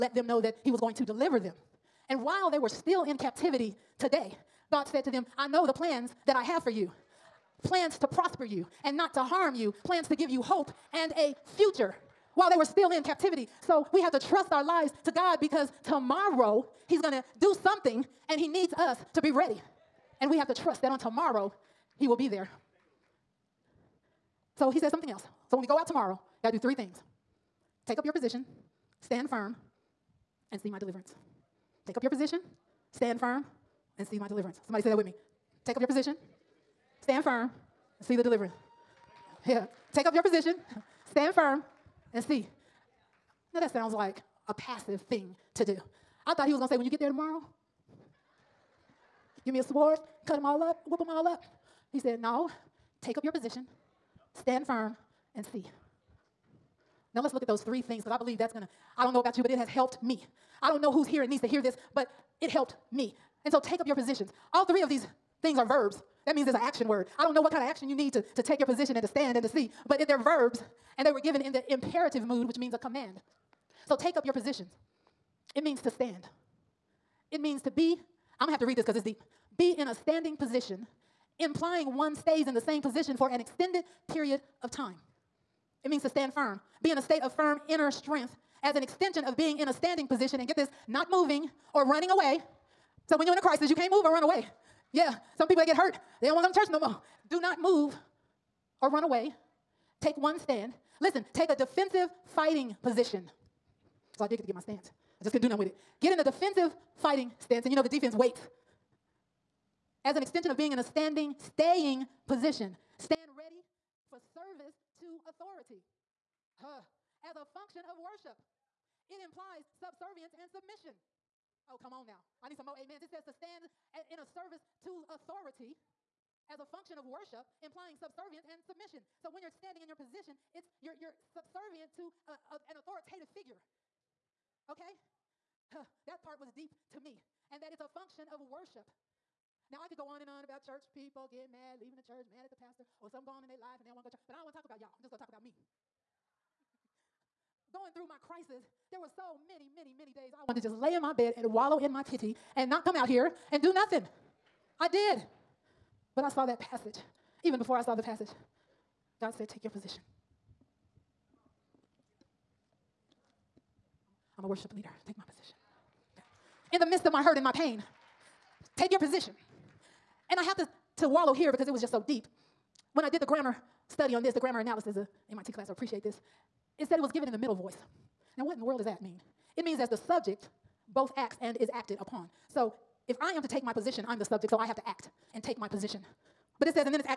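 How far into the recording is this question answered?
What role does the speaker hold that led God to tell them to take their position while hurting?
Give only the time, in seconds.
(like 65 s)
164 s.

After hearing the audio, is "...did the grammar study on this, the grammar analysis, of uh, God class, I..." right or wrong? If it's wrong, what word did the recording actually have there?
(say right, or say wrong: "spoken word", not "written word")
wrong: "MIT", not "God".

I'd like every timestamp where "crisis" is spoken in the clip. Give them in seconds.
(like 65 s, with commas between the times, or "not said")
93 s, 148 s.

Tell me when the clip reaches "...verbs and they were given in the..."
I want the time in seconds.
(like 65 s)
70 s.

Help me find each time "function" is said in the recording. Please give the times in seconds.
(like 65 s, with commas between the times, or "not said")
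117 s, 126 s, 137 s.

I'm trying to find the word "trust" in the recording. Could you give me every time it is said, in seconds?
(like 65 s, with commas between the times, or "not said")
14 s, 20 s.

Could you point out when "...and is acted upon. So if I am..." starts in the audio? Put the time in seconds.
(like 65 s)
181 s.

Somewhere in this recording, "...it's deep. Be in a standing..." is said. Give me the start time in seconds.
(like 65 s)
78 s.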